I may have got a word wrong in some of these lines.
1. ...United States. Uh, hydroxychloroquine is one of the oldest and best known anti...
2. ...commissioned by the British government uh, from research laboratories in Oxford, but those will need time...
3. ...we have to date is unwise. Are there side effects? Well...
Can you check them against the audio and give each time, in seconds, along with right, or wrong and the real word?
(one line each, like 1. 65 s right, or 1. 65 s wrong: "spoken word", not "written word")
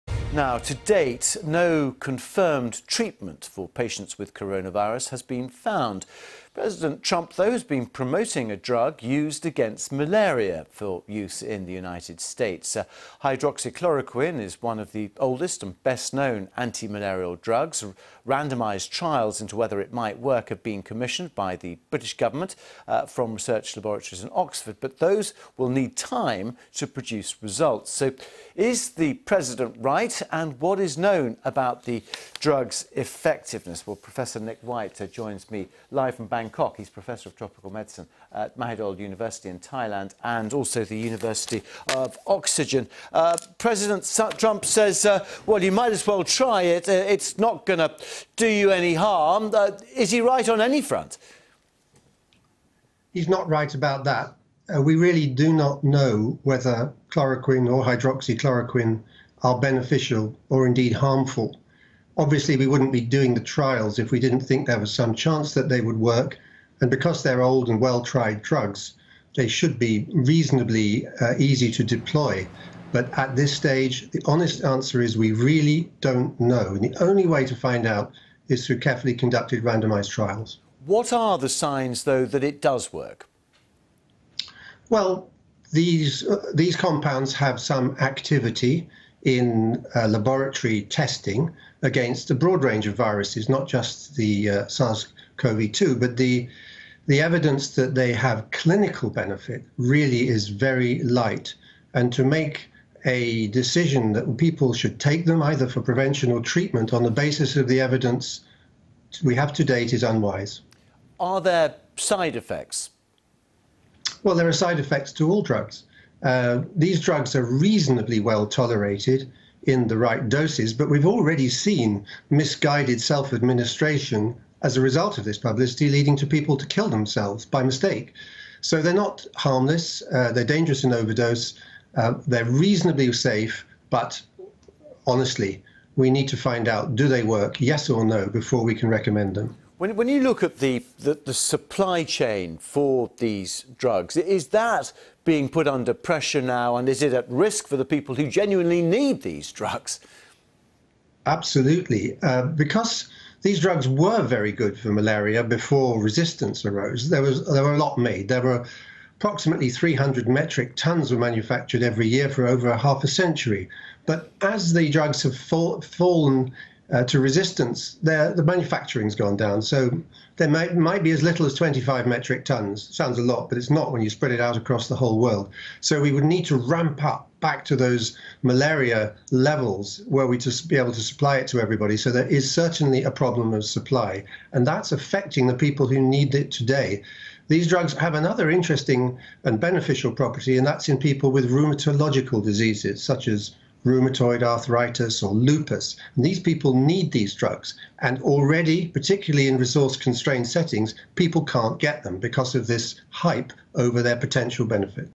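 1. 11 s right
2. 20 s right
3. 109 s right.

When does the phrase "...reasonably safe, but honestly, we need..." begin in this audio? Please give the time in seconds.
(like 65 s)
132 s.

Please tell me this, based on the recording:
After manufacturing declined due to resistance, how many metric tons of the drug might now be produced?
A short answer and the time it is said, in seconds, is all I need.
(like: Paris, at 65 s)
25, at 171 s.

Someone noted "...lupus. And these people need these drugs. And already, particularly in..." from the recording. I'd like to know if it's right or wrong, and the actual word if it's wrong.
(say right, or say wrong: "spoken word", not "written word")
right.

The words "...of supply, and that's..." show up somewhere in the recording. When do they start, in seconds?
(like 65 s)
183 s.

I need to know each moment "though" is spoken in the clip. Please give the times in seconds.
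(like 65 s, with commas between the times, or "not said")
7 s, 82 s.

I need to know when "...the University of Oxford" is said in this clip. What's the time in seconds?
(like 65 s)
40 s.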